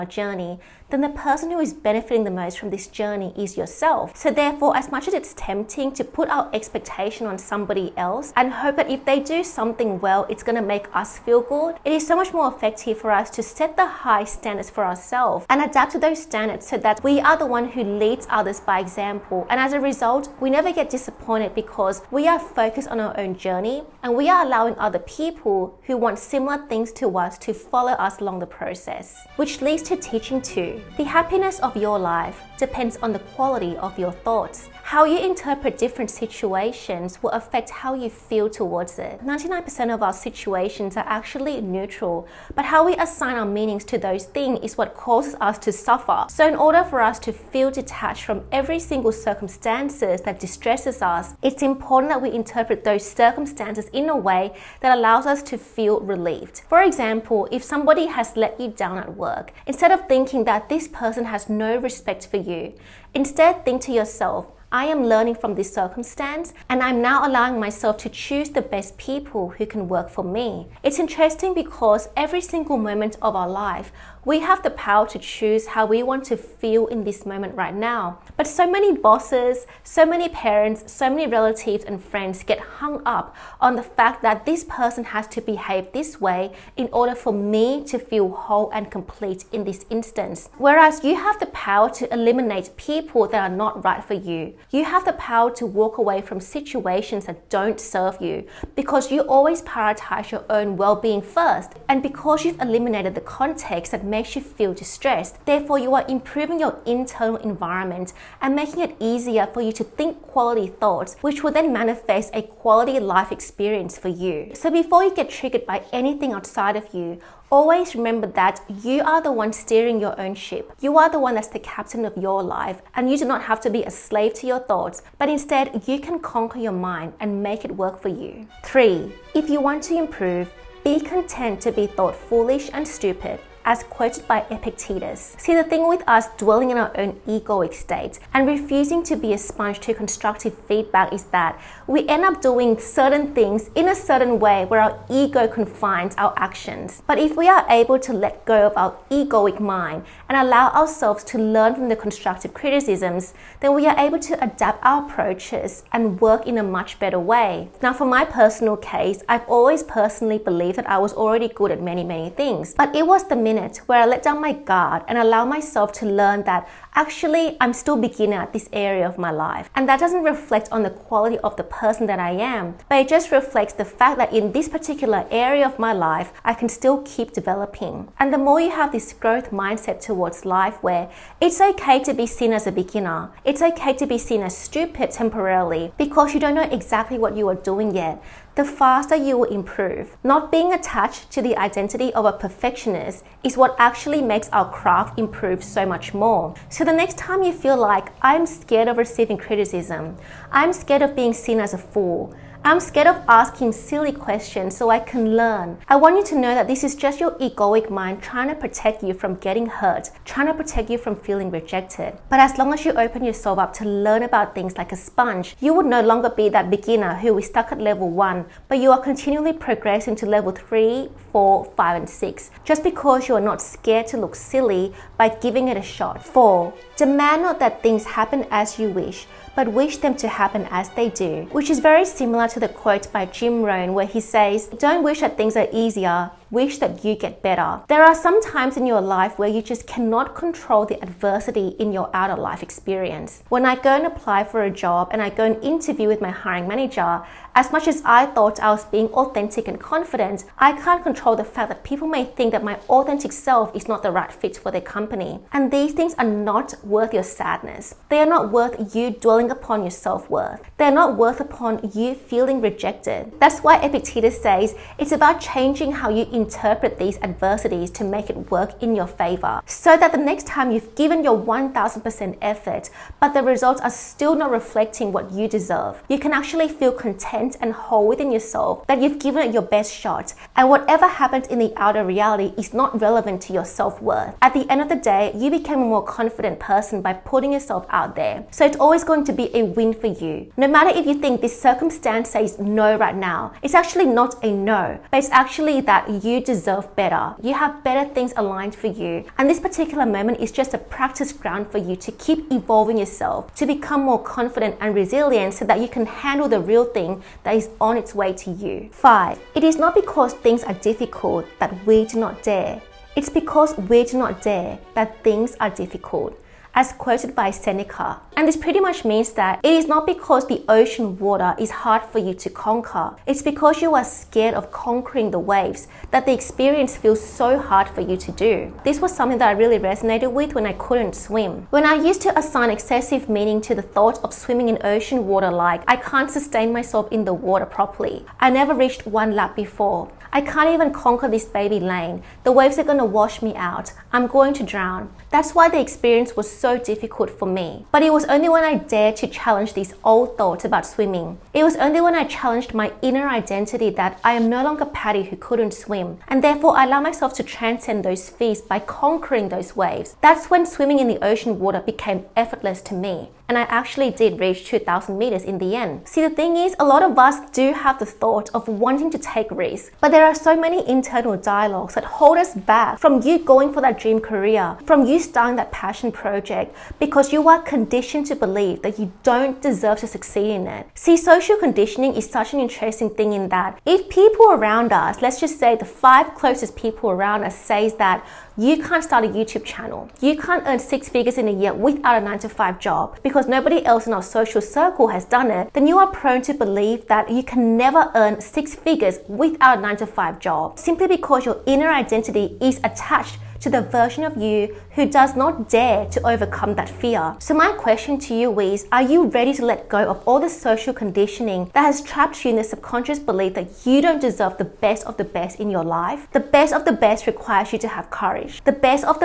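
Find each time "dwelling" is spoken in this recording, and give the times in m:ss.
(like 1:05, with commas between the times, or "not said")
2:16, 4:19.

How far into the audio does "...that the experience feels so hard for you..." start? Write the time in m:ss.
5:26.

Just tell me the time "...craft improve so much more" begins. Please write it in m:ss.
3:14.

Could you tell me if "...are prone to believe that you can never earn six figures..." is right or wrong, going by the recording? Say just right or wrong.
right.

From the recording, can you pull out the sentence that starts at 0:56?
For example, if somebody has let you down at work, instead of thinking that that this person has no respect for you.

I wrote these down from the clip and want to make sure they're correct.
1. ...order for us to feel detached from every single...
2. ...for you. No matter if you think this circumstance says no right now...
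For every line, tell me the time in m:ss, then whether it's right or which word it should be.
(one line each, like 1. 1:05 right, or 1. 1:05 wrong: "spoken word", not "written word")
1. 0:46 right
2. 4:49 right.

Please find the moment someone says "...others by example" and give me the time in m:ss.
0:18.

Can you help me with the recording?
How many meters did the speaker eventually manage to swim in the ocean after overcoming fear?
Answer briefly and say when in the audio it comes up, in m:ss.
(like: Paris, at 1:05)
2000 meters, at 6:04.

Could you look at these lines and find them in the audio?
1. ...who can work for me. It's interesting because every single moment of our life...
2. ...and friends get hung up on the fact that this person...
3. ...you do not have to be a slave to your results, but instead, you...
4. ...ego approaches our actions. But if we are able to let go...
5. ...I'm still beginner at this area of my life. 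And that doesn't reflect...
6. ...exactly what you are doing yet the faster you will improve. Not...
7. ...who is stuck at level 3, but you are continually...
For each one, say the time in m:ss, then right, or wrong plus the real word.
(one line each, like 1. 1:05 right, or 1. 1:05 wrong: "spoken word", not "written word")
1. 1:09 right
2. 1:21 right
3. 2:03 wrong: "thoughts", not "results"
4. 2:25 wrong: "confines", not "approaches"
5. 2:47 right
6. 3:06 right
7. 3:37 wrong: "1", not "3".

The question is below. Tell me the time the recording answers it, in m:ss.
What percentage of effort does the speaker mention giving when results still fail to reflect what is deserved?
4:31.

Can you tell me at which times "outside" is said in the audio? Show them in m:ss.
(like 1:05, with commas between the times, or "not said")
1:56.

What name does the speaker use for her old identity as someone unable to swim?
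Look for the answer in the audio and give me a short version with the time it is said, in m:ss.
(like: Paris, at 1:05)
Patty, at 5:54.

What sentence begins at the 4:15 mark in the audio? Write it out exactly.
And these things are not worth your sadness.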